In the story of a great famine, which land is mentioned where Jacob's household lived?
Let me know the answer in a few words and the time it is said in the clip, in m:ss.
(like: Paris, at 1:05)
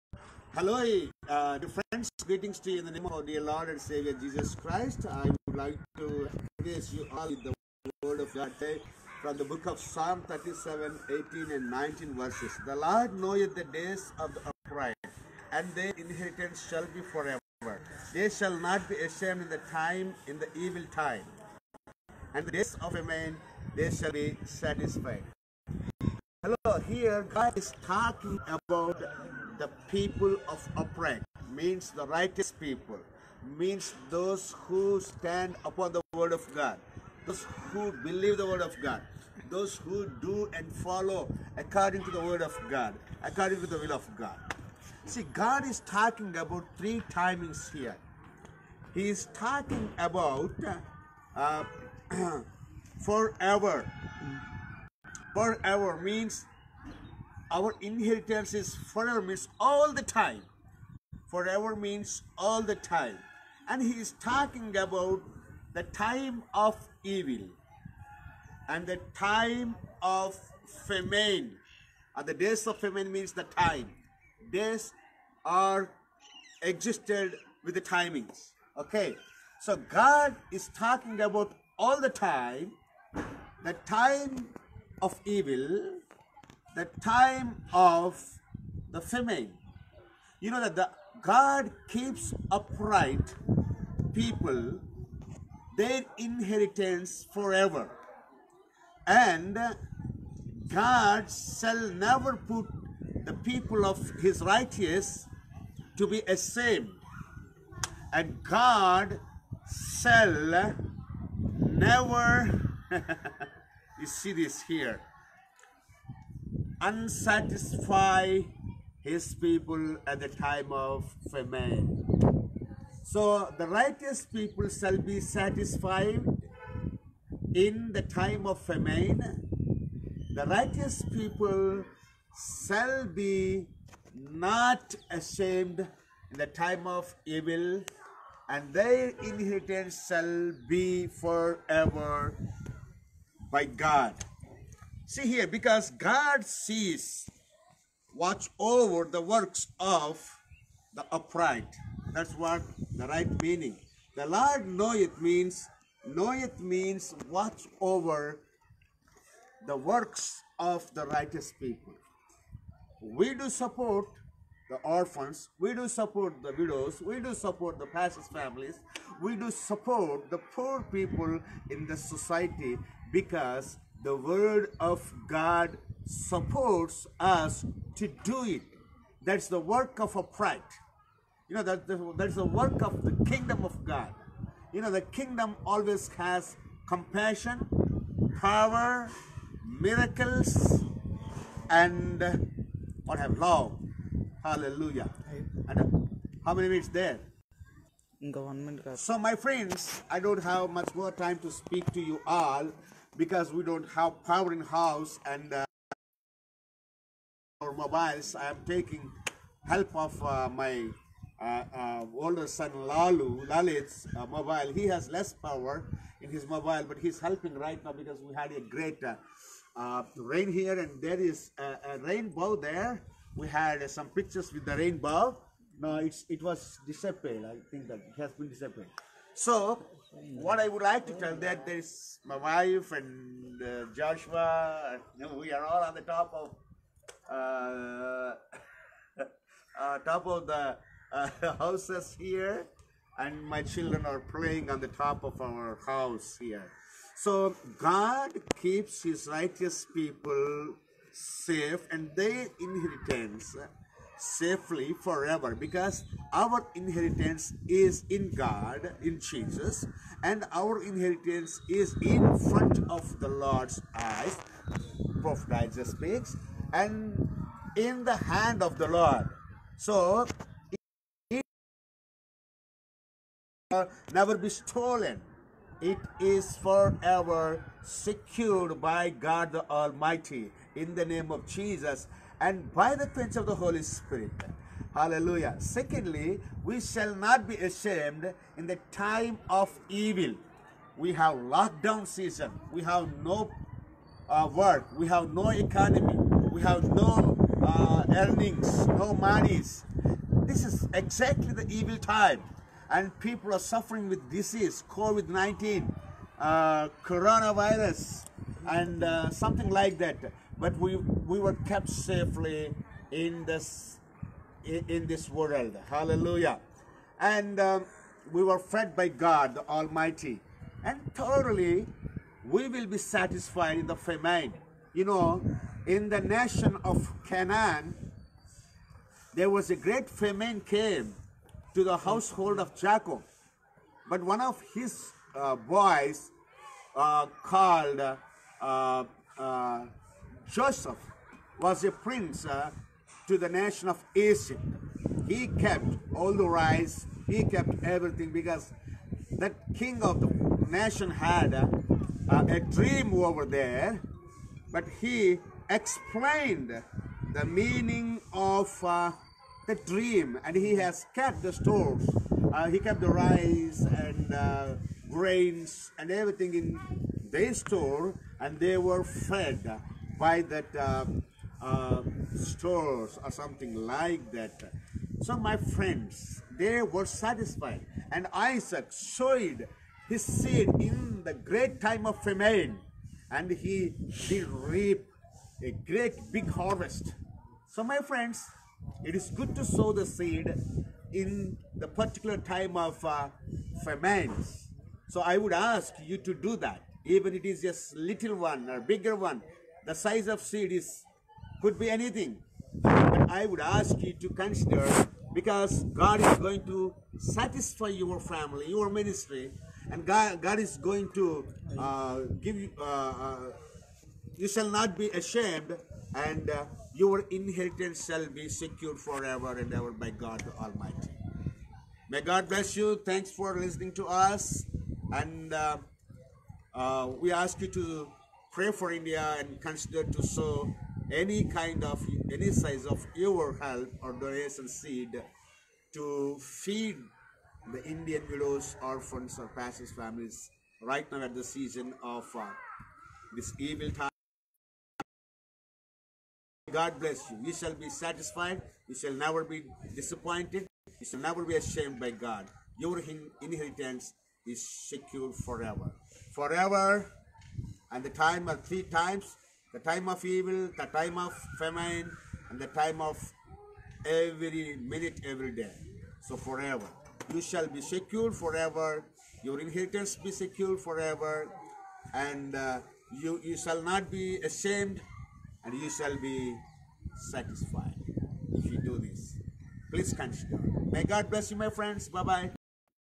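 Canaan, at 5:27.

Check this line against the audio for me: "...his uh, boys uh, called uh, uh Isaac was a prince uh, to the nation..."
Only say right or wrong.
wrong.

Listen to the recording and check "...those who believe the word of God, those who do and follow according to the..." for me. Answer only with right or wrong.
right.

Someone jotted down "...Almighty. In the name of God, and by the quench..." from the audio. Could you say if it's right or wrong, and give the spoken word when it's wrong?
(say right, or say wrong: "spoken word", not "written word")
wrong: "Jesus", not "God".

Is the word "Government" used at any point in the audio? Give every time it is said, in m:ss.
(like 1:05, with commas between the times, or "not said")
3:18.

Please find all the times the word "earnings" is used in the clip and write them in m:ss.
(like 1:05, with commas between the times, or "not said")
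4:58.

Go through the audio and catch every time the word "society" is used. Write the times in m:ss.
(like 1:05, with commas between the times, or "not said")
2:51.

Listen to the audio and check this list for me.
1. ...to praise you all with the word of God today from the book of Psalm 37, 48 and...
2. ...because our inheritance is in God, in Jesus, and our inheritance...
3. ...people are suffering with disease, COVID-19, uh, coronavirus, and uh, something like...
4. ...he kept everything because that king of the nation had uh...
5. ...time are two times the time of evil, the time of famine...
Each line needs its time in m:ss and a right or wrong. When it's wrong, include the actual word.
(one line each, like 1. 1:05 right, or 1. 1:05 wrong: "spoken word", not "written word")
1. 0:05 wrong: "18", not "48"
2. 4:15 right
3. 5:03 right
4. 5:47 right
5. 7:38 wrong: "three", not "two".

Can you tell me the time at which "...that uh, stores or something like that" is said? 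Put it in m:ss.
6:10.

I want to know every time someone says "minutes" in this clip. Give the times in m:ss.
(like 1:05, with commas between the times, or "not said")
3:16, 7:44.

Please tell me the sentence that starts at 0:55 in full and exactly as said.
Forever means our inheritance is forever means all the time.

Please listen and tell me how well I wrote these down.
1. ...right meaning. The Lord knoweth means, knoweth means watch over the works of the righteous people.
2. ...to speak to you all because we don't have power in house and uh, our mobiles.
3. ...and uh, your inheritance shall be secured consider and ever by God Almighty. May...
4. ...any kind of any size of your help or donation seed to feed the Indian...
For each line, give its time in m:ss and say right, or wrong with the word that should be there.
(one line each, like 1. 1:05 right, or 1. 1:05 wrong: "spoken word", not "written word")
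1. 2:33 right
2. 3:21 right
3. 6:56 wrong: "forever", not "consider"
4. 7:11 right.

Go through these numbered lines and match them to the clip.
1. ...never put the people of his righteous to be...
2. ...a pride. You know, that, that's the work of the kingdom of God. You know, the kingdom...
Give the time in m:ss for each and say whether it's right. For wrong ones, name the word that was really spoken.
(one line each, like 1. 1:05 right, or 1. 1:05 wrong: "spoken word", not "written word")
1. 1:41 right
2. 3:00 right.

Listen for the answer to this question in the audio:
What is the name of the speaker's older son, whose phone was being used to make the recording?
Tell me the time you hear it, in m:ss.
3:33.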